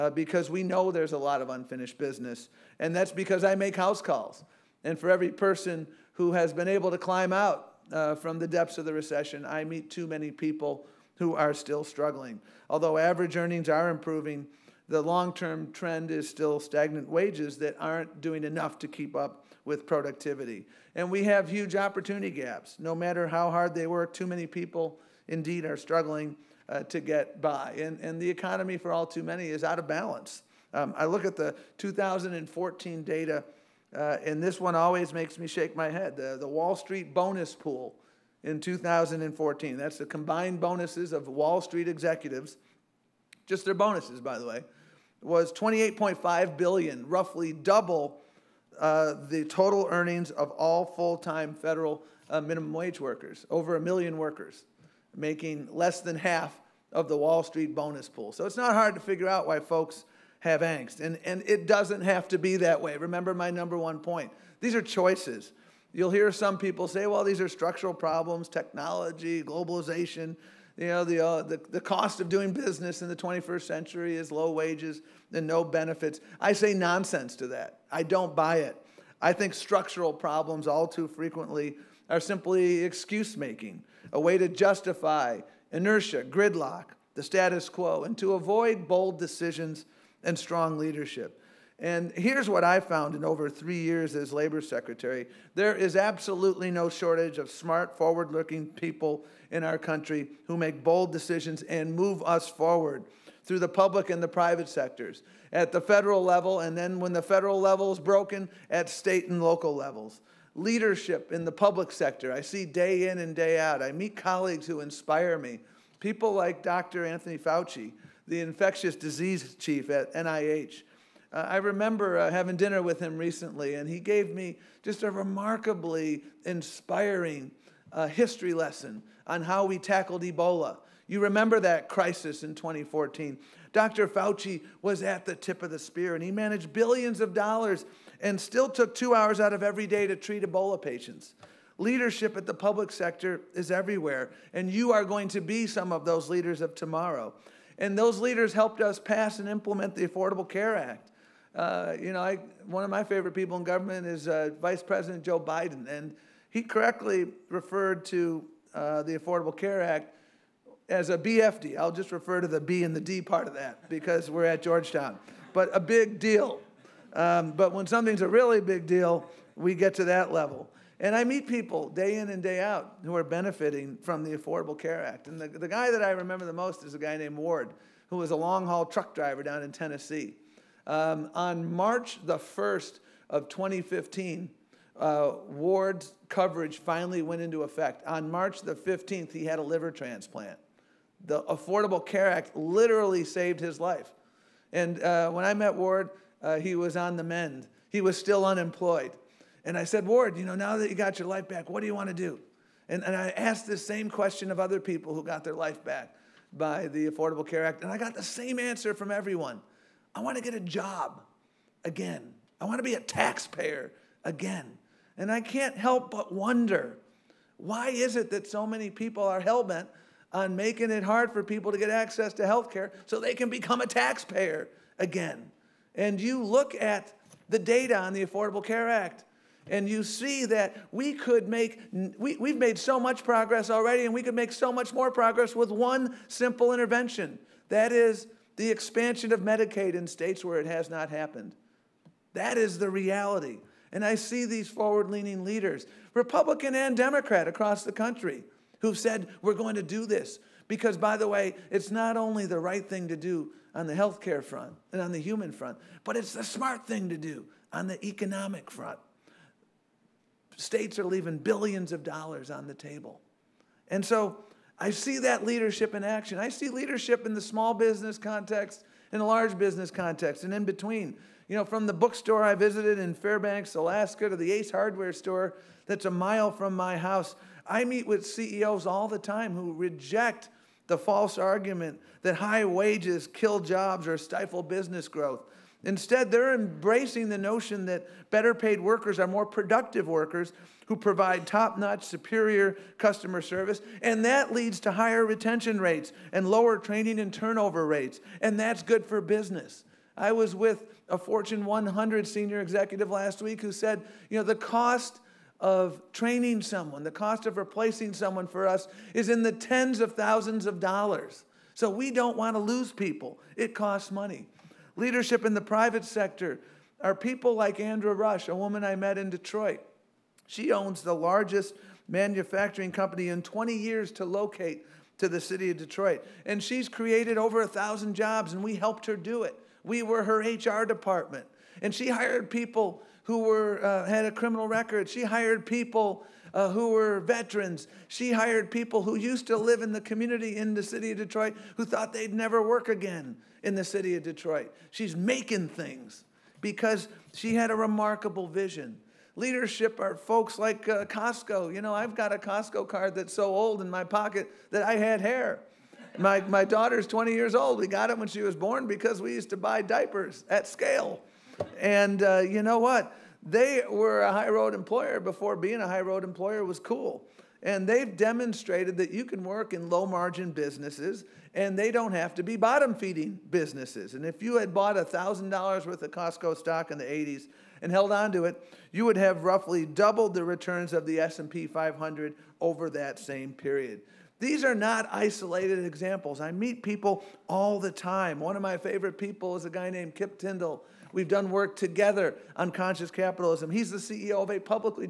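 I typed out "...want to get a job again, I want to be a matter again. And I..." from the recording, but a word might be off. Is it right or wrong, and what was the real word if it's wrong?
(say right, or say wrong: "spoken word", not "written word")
wrong: "taxpayer", not "matter".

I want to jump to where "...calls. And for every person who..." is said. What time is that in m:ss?
0:04.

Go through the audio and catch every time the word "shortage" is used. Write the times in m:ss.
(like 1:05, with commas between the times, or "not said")
1:36.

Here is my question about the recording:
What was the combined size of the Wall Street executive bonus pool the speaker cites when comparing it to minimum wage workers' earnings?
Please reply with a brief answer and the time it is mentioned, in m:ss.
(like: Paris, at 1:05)
$28.5 billion, at 0:45.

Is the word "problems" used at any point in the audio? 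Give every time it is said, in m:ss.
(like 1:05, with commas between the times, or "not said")
1:07, 1:20.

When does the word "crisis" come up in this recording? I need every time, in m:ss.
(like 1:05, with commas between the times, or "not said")
2:11.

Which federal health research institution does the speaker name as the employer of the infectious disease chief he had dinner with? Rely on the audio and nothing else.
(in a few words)
NIH.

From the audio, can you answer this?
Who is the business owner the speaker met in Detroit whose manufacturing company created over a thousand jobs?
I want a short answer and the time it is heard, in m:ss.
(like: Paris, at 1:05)
Andra Rush, at 5:17.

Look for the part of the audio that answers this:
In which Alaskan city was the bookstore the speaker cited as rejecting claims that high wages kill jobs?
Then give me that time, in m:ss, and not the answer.
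4:33.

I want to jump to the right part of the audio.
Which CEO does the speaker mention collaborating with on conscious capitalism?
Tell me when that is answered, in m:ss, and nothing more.
6:30.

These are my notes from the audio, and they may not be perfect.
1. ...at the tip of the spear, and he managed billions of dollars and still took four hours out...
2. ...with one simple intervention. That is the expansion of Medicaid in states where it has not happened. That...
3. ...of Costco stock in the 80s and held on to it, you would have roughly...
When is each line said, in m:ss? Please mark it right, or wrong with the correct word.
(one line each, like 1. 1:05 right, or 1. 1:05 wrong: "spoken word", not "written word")
1. 2:15 wrong: "two", not "four"
2. 3:55 right
3. 6:16 right.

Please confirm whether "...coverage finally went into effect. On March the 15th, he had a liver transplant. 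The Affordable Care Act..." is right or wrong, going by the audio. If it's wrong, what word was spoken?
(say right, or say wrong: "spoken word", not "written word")
right.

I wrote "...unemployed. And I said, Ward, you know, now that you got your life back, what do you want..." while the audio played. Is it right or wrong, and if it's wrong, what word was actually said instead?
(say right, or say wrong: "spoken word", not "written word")
right.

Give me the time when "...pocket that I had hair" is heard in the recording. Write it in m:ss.
5:54.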